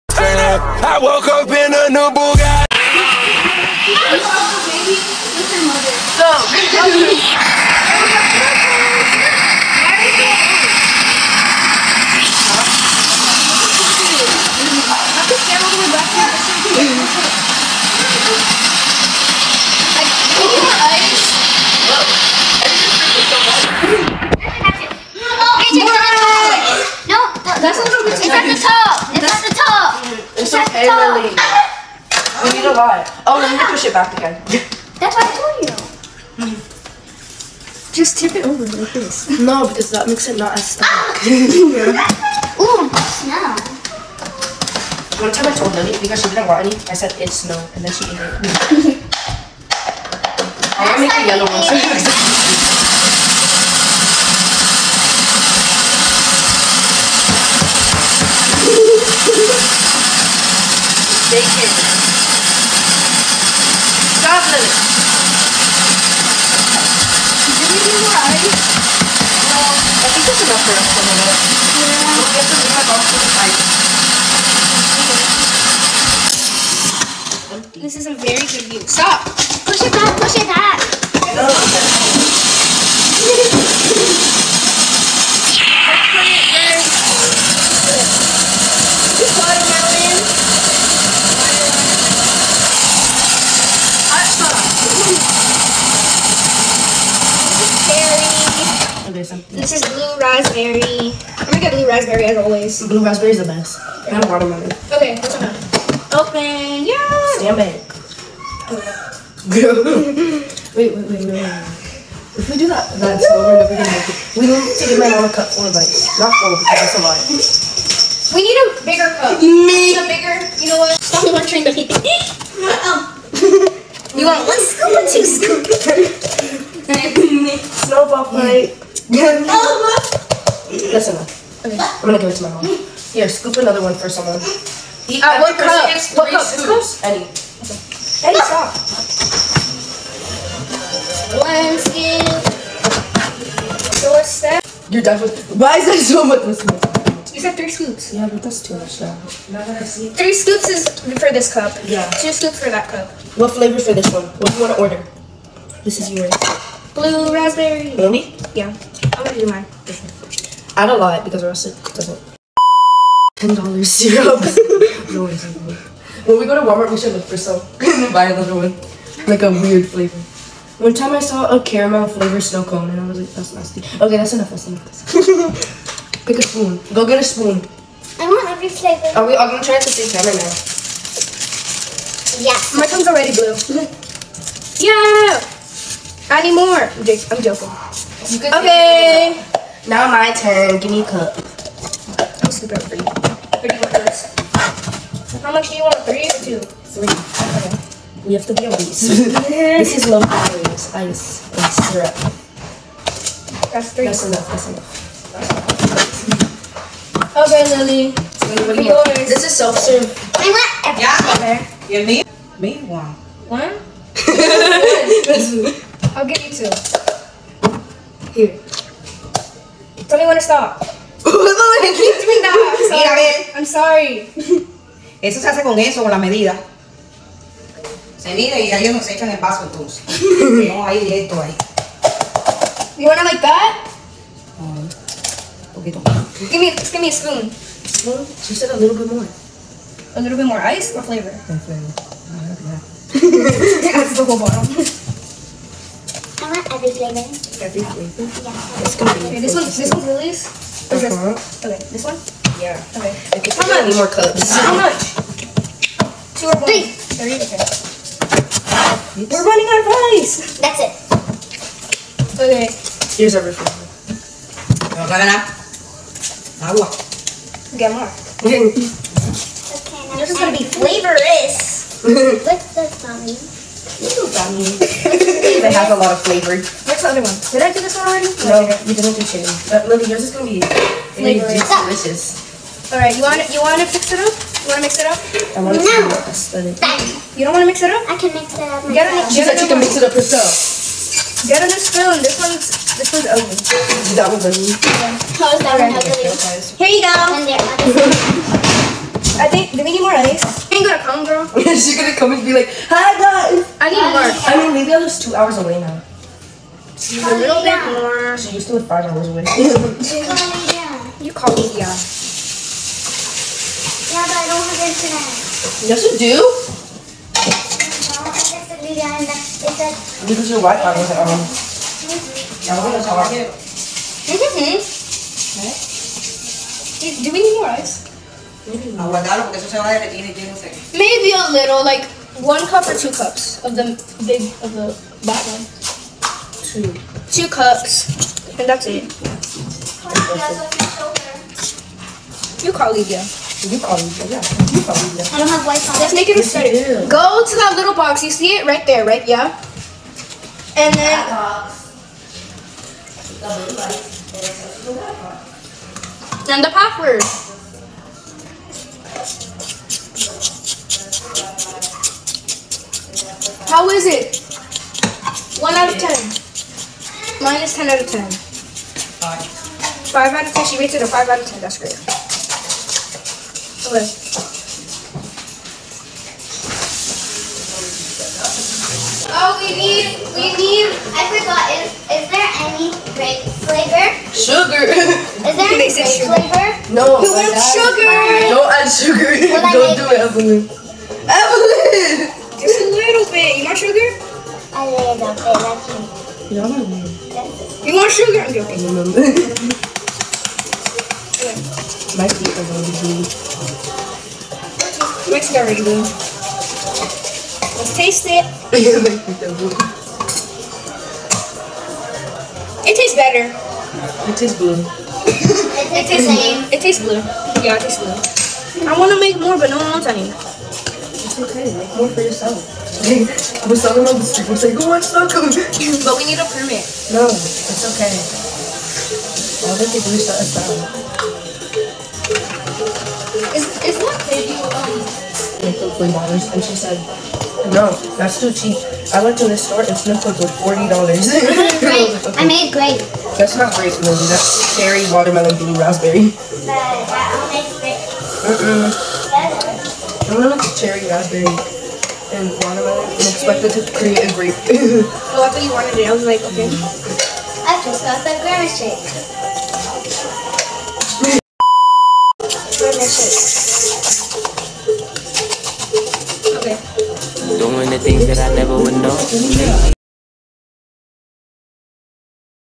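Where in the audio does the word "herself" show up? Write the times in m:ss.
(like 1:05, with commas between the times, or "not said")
4:50.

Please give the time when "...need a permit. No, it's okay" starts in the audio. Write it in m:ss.
7:06.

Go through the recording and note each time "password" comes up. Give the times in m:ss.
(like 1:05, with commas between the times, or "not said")
5:56.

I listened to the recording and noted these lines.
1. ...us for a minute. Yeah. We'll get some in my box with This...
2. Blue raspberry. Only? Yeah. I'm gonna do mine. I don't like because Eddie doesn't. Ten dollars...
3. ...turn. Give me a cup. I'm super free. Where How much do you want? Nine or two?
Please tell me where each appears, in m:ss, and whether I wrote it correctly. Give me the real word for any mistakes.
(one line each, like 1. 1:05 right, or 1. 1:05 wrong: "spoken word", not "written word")
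1. 1:10 right
2. 2:36 wrong: "Russet", not "Eddie"
3. 3:10 wrong: "Three", not "Nine".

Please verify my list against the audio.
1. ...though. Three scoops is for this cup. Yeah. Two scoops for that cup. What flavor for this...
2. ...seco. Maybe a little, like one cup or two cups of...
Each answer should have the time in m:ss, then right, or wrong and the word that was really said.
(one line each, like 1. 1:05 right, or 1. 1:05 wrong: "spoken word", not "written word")
1. 2:28 right
2. 5:30 right.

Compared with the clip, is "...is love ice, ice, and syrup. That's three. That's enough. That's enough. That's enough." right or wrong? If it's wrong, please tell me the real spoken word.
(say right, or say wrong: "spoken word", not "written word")
right.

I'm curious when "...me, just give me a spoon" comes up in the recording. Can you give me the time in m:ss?
3:56.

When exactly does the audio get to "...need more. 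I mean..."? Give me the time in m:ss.
5:03.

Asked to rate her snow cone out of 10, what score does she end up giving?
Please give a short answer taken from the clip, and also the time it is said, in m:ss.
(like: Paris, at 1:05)
5 out of 10, at 6:08.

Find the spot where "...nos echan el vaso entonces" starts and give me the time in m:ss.
3:48.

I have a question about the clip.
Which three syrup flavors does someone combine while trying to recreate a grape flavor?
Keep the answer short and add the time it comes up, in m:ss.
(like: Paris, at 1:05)
Cherry, watermelon, blue raspberry, at 7:24.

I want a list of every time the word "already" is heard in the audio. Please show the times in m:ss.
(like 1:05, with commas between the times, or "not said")
3:03, 4:38, 6:45.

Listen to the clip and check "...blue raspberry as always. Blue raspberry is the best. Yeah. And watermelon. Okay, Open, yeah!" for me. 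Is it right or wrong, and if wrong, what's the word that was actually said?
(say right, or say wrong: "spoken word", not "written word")
right.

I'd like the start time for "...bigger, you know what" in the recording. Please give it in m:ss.
2:00.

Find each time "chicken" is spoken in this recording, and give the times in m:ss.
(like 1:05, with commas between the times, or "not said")
4:39.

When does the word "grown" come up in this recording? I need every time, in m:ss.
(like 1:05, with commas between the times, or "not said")
not said.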